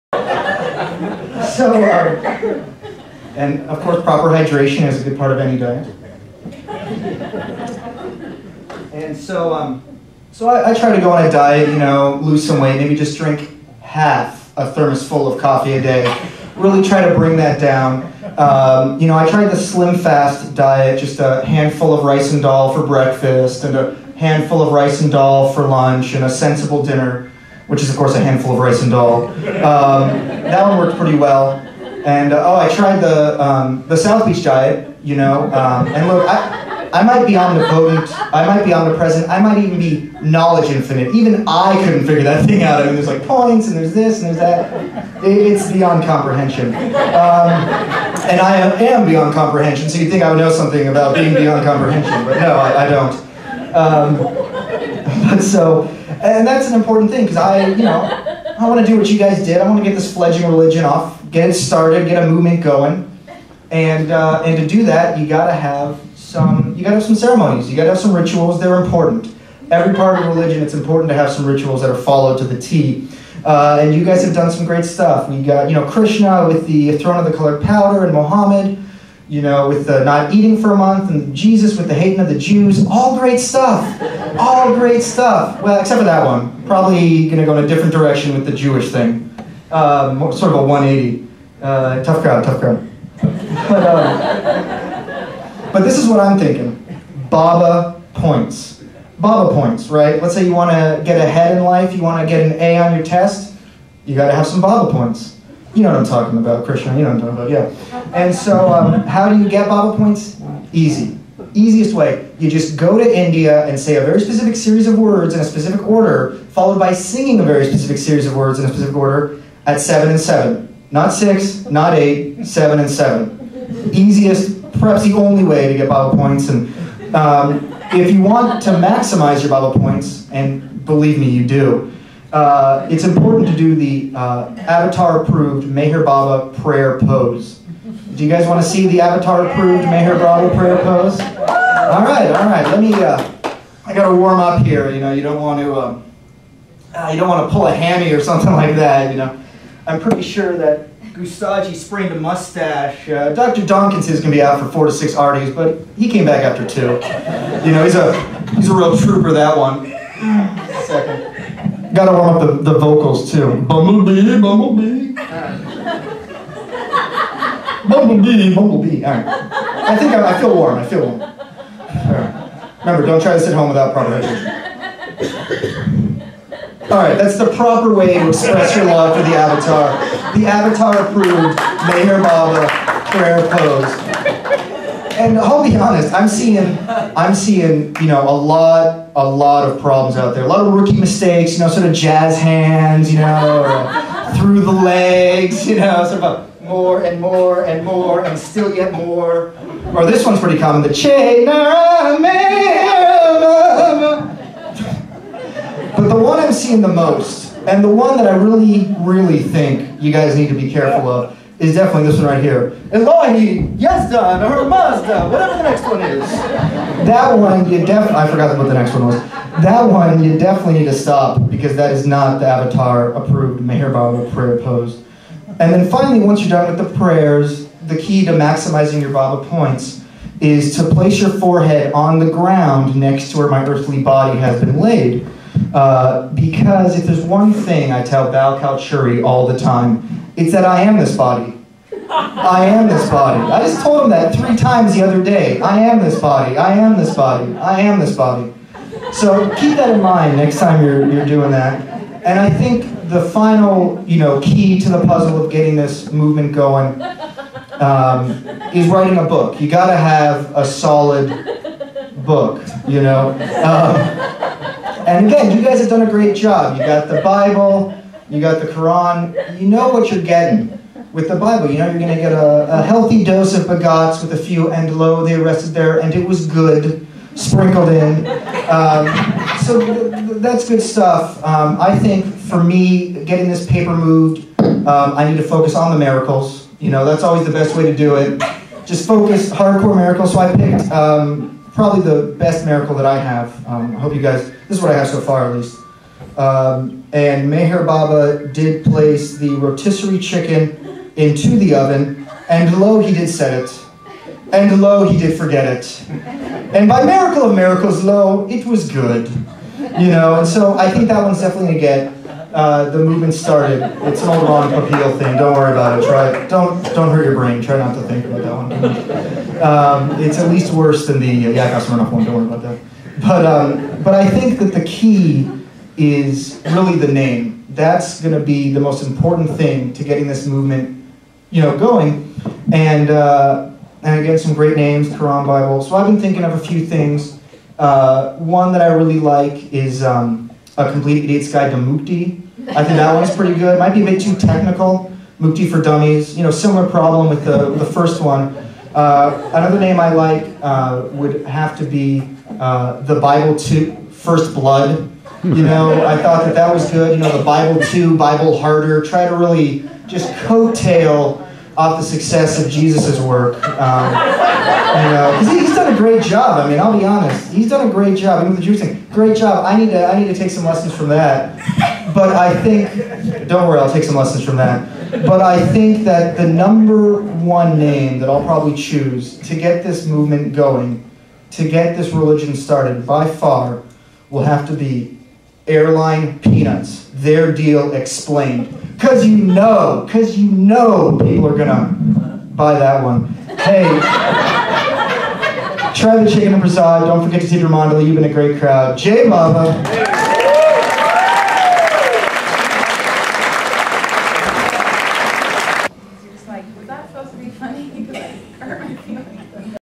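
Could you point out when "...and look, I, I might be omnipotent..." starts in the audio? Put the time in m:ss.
0:35.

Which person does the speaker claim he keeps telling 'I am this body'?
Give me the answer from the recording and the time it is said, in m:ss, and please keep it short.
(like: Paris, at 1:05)
Bhau Kalchuri, at 3:58.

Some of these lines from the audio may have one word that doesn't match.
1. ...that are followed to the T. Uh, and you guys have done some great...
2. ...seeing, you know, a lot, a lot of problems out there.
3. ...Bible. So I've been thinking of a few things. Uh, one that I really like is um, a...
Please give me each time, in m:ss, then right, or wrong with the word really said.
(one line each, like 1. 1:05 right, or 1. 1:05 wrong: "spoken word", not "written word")
1. 1:11 right
2. 3:07 right
3. 5:35 right.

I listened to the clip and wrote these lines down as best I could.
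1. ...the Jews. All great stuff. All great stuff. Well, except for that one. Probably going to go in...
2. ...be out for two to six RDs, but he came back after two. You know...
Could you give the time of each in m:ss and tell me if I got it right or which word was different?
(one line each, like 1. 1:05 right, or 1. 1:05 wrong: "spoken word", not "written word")
1. 1:22 right
2. 2:34 wrong: "four", not "two".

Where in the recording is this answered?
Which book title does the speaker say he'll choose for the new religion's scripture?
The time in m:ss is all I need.
6:25.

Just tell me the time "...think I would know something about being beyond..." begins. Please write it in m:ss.
0:50.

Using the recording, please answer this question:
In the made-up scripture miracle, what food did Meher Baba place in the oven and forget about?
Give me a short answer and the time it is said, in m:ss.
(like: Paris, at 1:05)
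rotisserie chicken, at 4:59.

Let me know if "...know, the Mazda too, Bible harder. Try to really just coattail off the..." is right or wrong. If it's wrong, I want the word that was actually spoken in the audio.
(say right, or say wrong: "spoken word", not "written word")
wrong: "Bible", not "Mazda".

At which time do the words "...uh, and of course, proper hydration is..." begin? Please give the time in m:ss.
0:01.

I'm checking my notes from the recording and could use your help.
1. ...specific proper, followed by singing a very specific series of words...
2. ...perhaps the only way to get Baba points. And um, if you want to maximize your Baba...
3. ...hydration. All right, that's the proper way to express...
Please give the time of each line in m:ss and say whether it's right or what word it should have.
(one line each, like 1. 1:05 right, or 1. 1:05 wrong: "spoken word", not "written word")
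1. 1:55 wrong: "order", not "proper"
2. 2:04 right
3. 2:54 right.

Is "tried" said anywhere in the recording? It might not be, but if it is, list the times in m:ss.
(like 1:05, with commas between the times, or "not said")
0:19, 0:32.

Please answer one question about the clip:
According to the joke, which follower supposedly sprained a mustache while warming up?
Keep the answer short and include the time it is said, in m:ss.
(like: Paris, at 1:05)
Gustadji, at 2:31.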